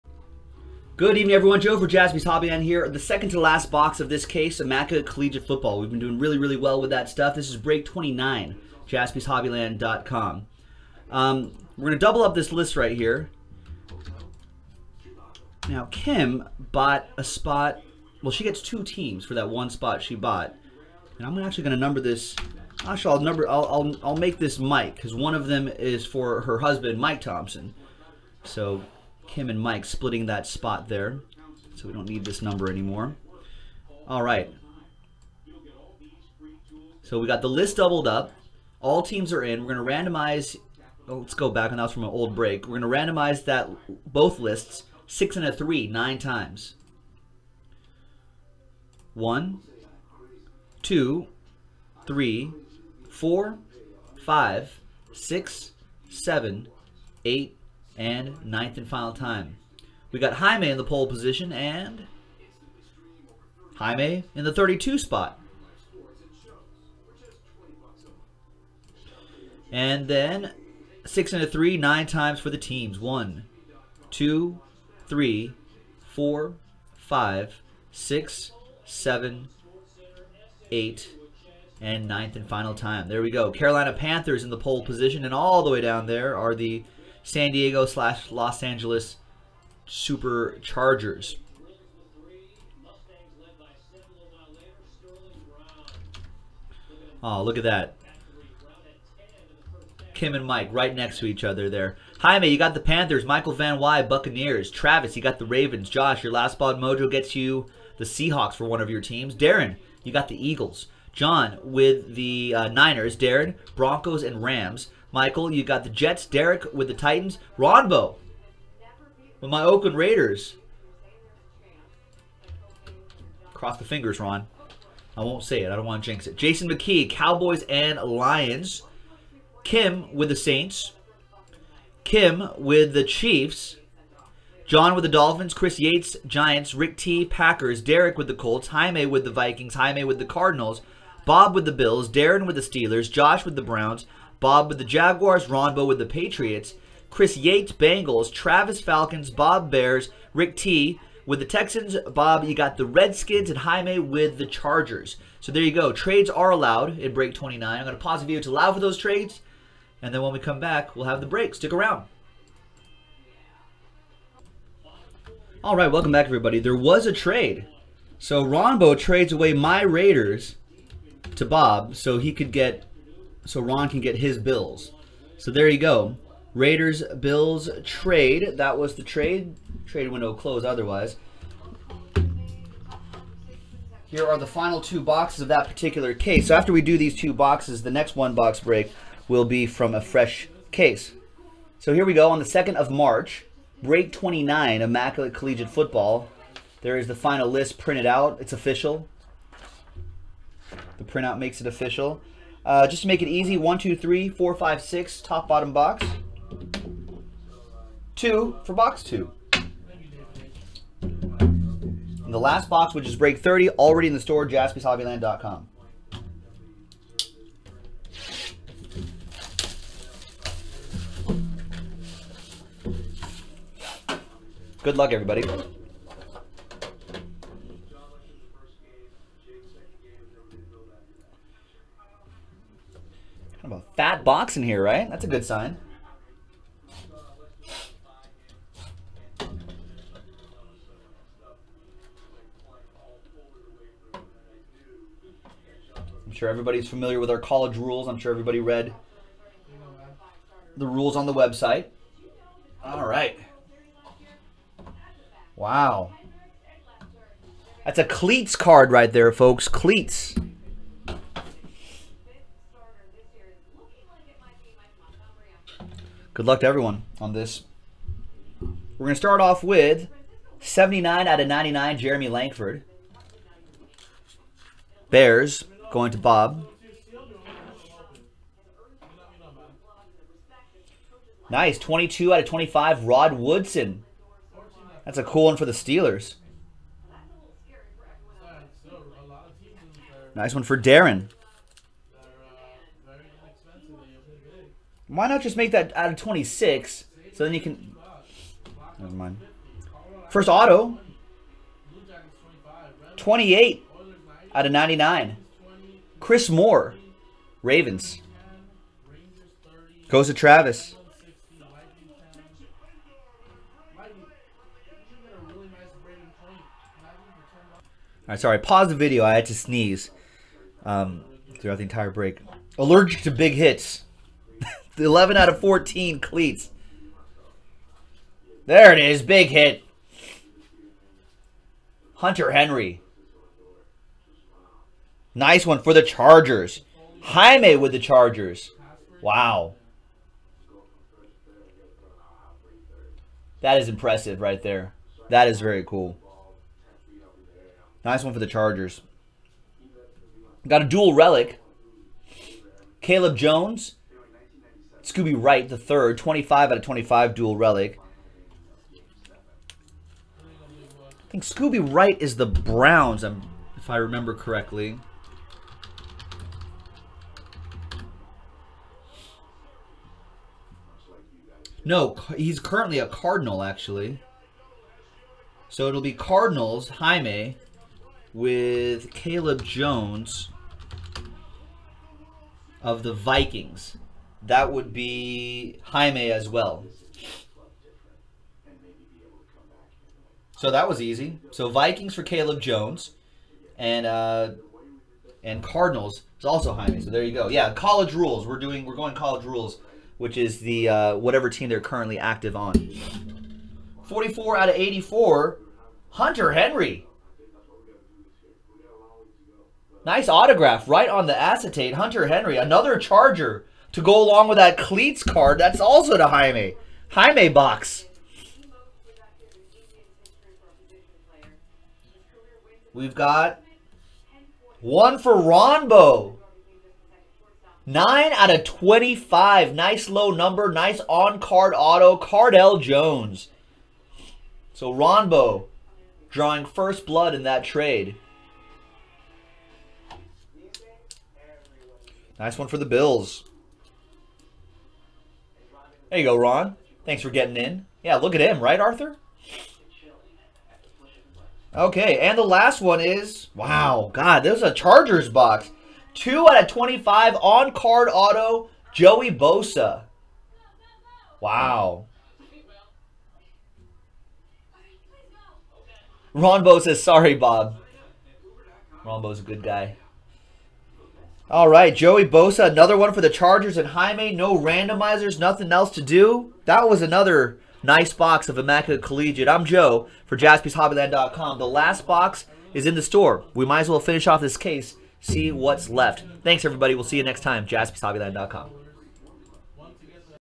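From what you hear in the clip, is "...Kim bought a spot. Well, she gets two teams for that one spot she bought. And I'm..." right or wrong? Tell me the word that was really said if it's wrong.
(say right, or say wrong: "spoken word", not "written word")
right.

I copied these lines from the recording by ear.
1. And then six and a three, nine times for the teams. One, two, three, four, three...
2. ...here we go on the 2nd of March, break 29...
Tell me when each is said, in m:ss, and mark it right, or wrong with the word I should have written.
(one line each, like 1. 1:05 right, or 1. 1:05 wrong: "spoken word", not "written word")
1. 1:09 wrong: "five", not "three"
2. 3:11 right.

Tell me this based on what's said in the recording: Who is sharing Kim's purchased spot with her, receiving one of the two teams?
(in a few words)
Mike Thompson.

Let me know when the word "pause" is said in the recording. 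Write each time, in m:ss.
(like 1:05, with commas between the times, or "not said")
2:38, 5:18.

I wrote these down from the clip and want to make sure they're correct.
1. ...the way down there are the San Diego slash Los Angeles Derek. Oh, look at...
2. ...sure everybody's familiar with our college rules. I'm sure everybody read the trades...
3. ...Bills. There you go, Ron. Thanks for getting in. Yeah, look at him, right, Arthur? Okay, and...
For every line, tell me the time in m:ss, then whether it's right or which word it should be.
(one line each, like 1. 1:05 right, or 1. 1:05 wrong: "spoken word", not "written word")
1. 1:25 wrong: "Superchargers", not "Derek"
2. 4:06 wrong: "rules", not "trades"
3. 7:22 right.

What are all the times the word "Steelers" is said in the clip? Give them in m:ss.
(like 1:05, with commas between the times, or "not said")
2:22, 4:45.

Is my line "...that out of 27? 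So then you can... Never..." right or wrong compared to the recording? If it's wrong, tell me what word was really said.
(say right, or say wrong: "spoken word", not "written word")
wrong: "26", not "27".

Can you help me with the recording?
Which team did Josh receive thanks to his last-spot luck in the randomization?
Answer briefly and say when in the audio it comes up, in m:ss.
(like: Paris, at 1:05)
Seahawks, at 1:48.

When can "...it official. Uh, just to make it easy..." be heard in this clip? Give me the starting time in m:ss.
3:21.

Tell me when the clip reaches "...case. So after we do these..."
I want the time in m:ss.
3:06.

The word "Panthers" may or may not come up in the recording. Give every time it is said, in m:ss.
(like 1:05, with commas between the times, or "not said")
1:23, 1:42.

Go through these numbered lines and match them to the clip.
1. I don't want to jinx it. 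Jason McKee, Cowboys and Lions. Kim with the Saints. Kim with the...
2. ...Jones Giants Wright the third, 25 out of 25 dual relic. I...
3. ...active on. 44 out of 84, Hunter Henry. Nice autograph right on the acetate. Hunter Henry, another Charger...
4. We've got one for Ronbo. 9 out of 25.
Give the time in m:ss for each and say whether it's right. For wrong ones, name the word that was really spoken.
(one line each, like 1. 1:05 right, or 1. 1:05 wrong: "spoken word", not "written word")
1. 2:05 right
2. 5:53 wrong: "Scooby", not "Giants"
3. 6:42 right
4. 7:02 right.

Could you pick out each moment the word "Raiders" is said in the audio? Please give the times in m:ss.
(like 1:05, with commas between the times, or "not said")
1:59, 2:49, 2:56.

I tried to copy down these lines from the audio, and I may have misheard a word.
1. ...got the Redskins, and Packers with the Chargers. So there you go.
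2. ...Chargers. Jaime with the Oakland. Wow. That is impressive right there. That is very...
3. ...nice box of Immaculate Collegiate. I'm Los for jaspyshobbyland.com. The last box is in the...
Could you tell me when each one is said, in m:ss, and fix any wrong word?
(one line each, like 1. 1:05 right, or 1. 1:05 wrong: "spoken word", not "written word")
1. 2:32 wrong: "Jaime", not "Packers"
2. 5:36 wrong: "Chargers", not "Oakland"
3. 7:57 wrong: "Joe", not "Los".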